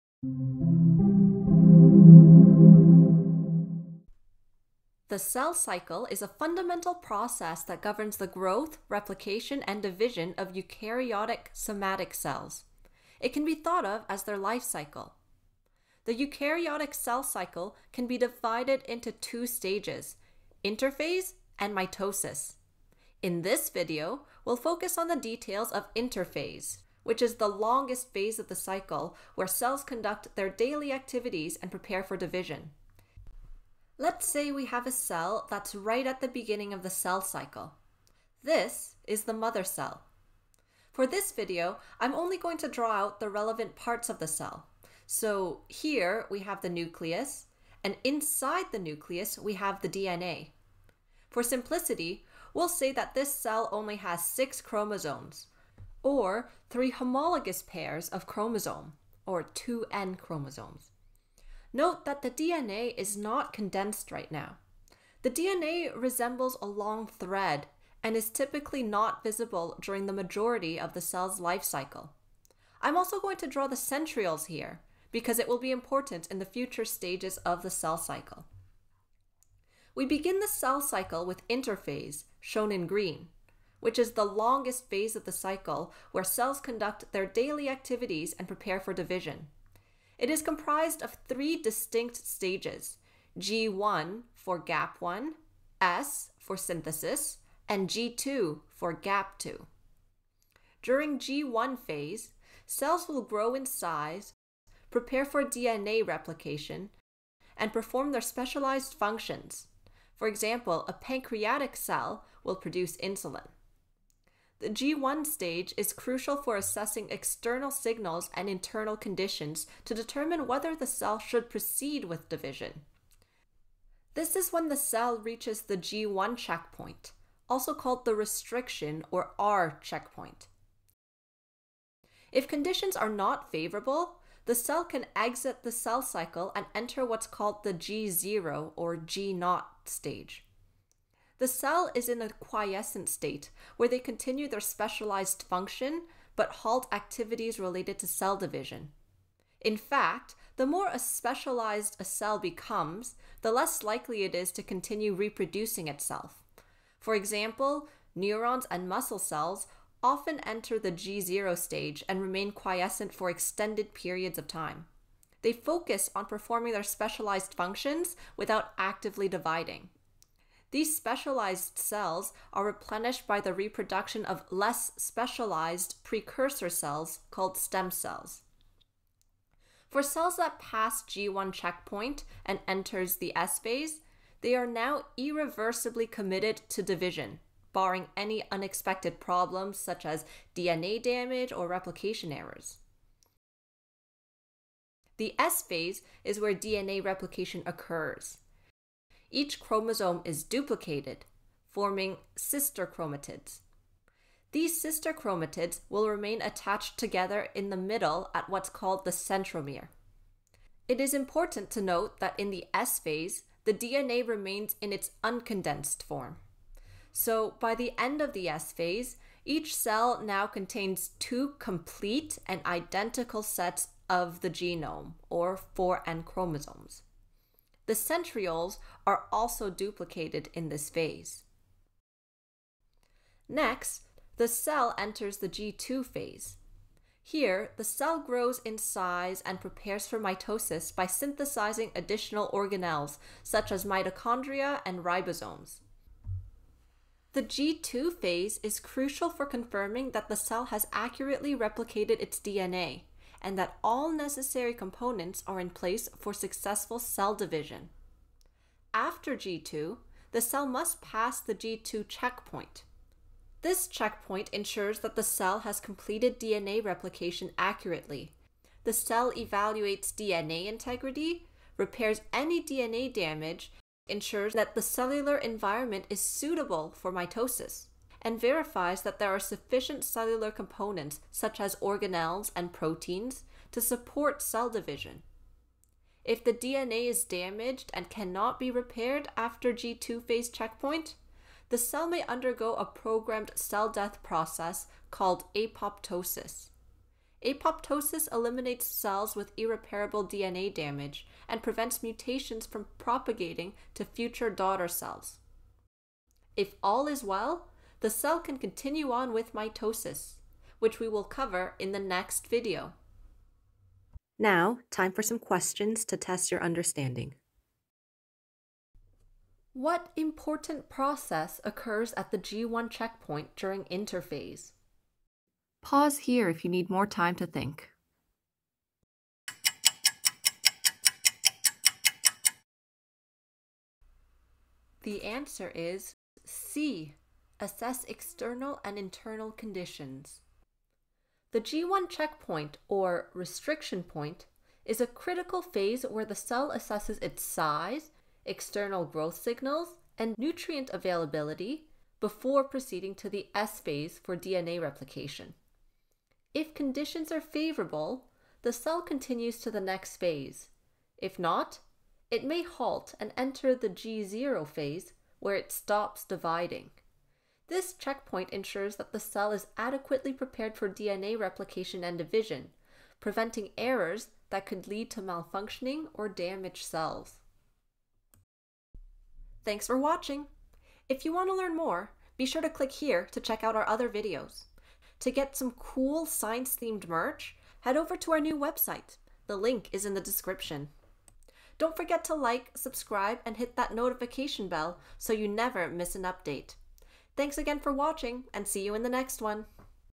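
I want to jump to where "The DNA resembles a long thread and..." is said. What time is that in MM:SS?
01:05.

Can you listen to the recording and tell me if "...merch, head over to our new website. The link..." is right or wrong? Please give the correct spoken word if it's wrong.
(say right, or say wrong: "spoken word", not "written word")
right.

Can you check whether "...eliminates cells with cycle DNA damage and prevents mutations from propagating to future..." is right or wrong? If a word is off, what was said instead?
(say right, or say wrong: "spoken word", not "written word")
wrong: "irreparable", not "cycle".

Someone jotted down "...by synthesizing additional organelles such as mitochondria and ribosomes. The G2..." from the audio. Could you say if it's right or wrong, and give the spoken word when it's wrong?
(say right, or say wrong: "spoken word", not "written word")
right.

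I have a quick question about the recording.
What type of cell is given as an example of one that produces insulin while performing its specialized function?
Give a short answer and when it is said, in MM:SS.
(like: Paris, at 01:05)
pancreatic cell, at 01:50.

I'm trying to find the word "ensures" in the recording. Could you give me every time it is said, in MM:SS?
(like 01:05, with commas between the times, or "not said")
04:24, 04:34, 06:08.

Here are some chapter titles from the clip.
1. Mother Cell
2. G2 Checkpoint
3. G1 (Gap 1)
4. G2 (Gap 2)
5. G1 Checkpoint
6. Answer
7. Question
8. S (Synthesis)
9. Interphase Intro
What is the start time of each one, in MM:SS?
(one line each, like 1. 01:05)
1. 00:37
2. 04:18
3. 01:41
4. 03:52
5. 02:03
6. 05:33
7. 05:14
8. 03:14
9. 01:19.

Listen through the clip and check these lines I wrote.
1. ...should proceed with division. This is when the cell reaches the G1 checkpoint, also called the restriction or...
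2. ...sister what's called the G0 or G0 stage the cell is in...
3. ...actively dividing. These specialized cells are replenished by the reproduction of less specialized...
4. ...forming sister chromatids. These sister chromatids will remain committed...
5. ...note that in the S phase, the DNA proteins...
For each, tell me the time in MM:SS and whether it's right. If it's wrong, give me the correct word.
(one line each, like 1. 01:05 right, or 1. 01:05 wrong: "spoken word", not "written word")
1. 02:01 right
2. 02:16 wrong: "enter", not "sister"
3. 02:48 right
4. 03:21 wrong: "attached", not "committed"
5. 03:31 wrong: "remains", not "proteins".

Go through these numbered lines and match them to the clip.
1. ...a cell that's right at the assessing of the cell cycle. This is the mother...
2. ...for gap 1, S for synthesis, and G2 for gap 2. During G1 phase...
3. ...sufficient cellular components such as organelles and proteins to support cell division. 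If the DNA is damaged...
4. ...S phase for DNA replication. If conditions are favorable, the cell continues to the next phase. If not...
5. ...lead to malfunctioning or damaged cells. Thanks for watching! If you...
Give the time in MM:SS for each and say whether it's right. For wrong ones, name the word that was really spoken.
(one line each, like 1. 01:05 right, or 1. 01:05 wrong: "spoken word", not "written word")
1. 00:34 wrong: "beginning", not "assessing"
2. 01:34 right
3. 04:39 right
4. 05:53 right
5. 06:14 right.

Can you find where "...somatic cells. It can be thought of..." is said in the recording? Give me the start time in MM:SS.
00:11.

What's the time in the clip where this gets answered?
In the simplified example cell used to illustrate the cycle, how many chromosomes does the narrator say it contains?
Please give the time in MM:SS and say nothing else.
00:54.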